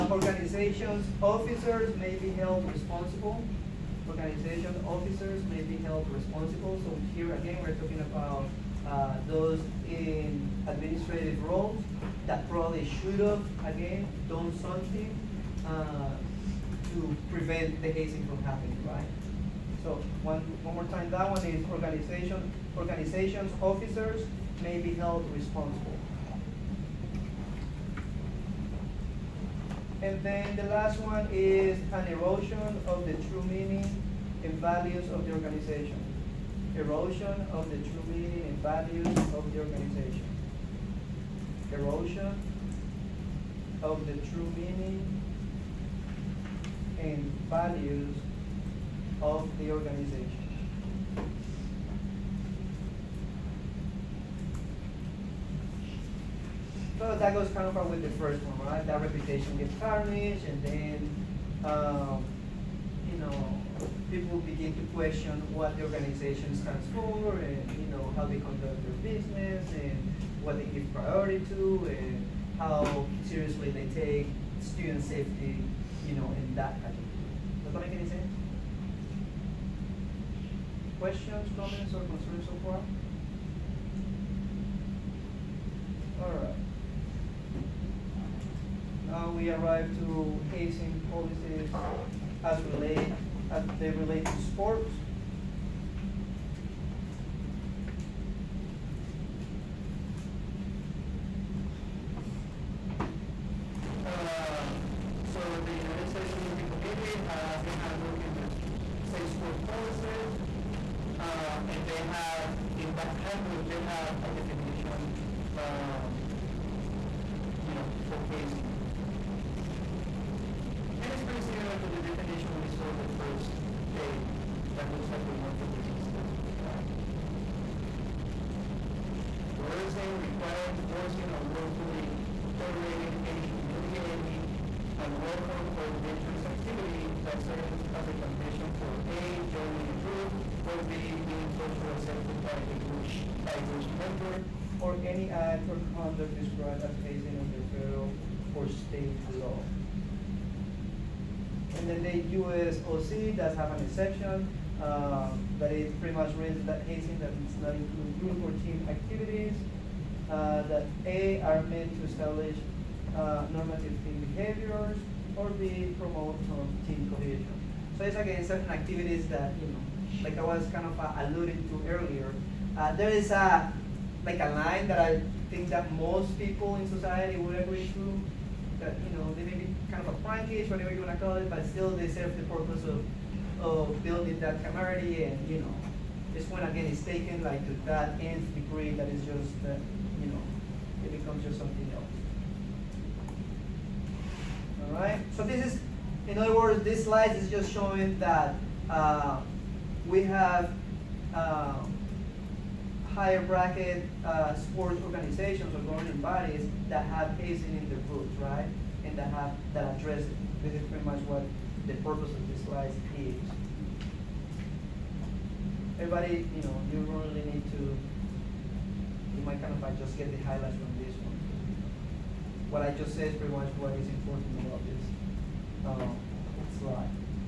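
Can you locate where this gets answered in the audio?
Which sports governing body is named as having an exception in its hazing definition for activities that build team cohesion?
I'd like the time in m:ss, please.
2:32.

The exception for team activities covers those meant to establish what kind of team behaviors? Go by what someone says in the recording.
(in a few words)
normative.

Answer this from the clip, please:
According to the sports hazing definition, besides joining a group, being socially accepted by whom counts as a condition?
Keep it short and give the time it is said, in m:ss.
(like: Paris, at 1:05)
a group member, at 2:23.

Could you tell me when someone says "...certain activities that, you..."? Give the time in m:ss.
2:48.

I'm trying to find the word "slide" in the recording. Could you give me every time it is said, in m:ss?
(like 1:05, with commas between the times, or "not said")
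3:17, 3:32, 3:46.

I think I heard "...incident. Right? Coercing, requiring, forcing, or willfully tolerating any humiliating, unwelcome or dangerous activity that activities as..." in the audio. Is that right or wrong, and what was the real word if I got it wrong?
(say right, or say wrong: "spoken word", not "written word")
wrong: "serves", not "activities".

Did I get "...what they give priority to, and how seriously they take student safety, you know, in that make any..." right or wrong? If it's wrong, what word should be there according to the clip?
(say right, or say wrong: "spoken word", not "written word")
right.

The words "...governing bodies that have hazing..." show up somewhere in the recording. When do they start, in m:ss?
3:25.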